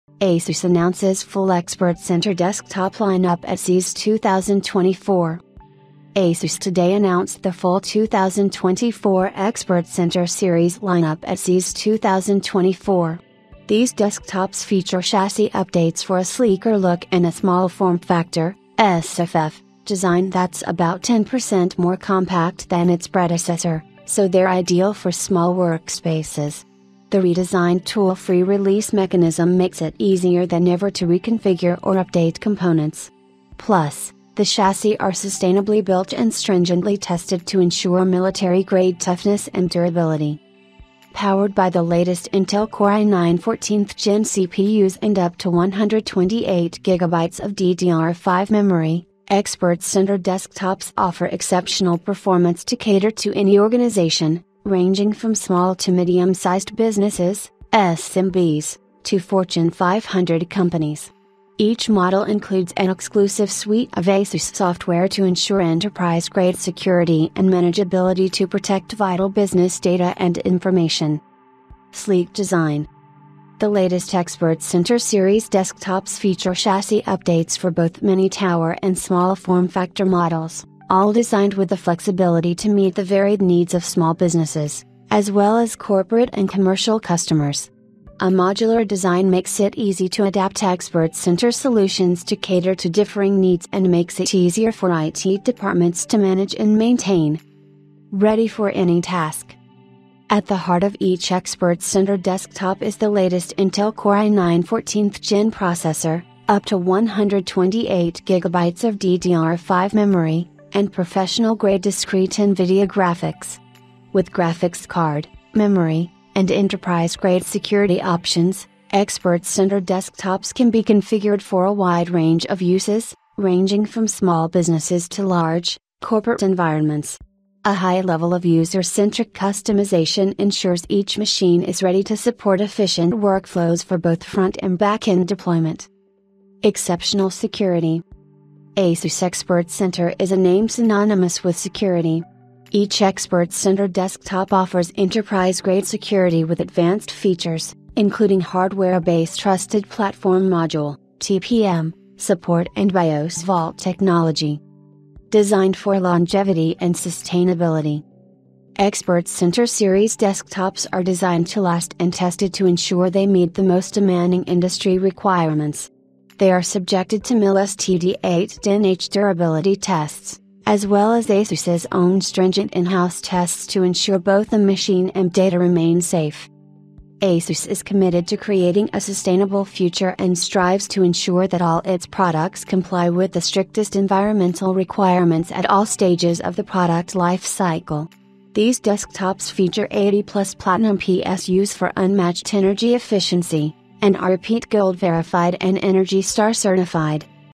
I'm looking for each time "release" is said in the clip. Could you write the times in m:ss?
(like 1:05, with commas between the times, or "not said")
0:28.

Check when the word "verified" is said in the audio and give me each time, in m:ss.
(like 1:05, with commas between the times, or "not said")
3:14.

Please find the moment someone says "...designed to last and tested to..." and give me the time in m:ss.
2:41.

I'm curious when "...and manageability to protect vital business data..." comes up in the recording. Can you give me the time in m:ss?
1:07.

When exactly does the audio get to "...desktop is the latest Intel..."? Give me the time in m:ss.
1:42.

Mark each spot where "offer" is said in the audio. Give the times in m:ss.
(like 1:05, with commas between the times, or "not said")
0:50, 2:24.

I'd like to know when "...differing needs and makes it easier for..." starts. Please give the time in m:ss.
1:32.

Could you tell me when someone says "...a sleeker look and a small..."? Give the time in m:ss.
0:16.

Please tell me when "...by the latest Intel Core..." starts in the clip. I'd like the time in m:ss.
0:41.